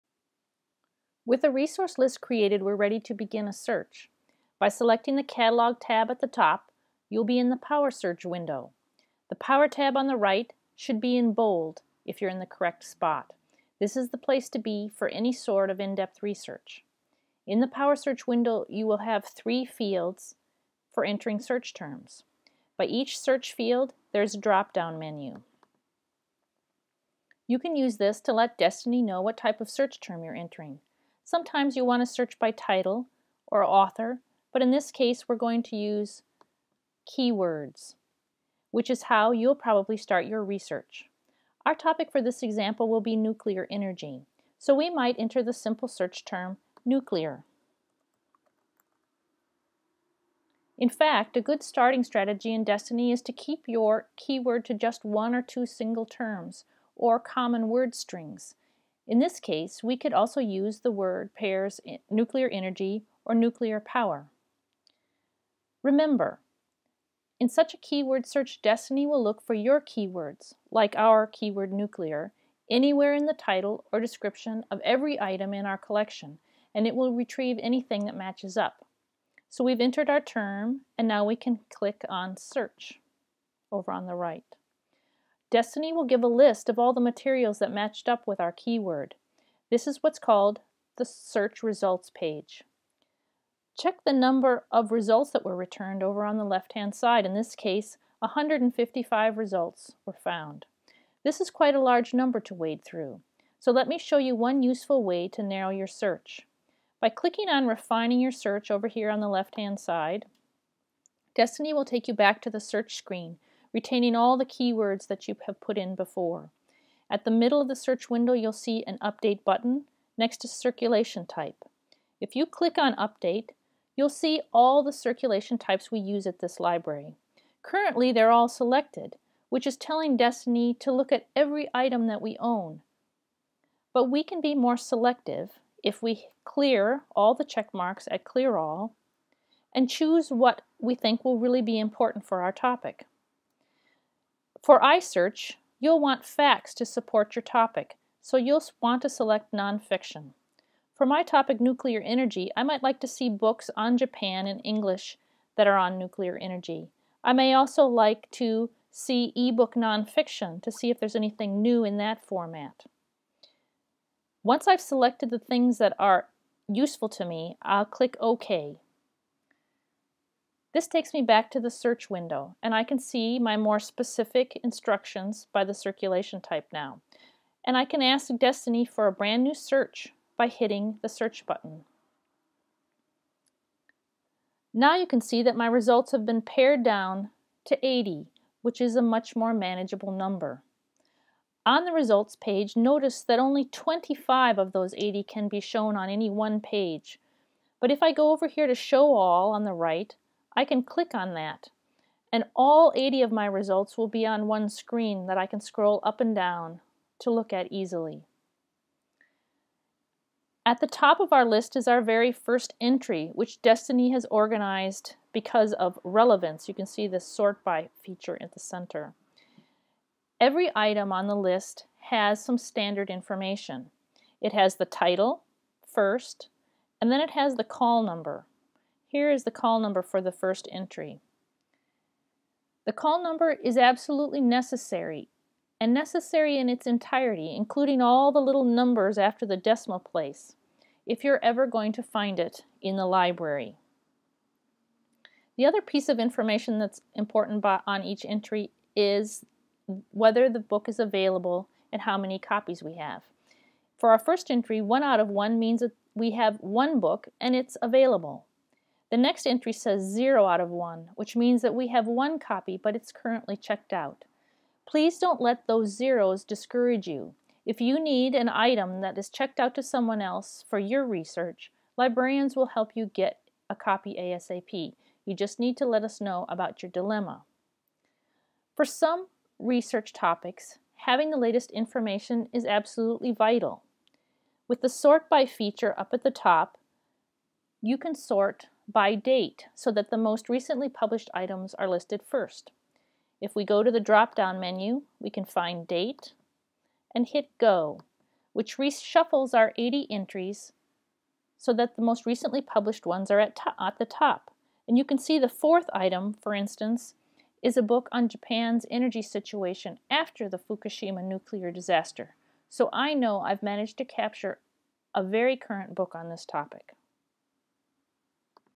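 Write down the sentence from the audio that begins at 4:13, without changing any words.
For our first entry, one out of one means that we have one book and it's available.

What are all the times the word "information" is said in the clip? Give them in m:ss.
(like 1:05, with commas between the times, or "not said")
3:43, 4:06, 4:41.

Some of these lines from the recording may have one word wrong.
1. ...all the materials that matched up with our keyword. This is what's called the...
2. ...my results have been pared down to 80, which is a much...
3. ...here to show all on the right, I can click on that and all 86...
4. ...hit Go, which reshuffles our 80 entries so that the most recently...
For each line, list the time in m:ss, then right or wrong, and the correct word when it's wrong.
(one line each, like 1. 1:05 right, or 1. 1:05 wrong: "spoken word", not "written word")
1. 1:26 right
2. 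3:05 right
3. 3:18 wrong: "80", not "86"
4. 4:57 right.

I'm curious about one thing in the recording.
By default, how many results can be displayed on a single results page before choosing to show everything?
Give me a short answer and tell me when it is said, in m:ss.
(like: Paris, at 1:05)
25, at 3:13.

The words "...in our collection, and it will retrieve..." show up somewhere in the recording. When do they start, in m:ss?
1:15.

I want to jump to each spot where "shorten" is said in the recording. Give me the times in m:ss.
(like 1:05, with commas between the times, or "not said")
not said.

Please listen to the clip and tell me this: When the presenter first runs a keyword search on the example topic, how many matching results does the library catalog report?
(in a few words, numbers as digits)
155.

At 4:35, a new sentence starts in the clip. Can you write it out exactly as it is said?
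You just need to let us know about your dilemma.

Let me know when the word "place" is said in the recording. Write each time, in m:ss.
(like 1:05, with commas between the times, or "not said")
0:14, 3:59.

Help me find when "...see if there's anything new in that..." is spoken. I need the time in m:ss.
2:40.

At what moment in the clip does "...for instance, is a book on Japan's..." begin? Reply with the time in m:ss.
5:06.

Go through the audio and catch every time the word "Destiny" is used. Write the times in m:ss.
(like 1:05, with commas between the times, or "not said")
0:28, 0:52, 1:08, 1:25, 1:51, 2:10, 2:58, 3:33.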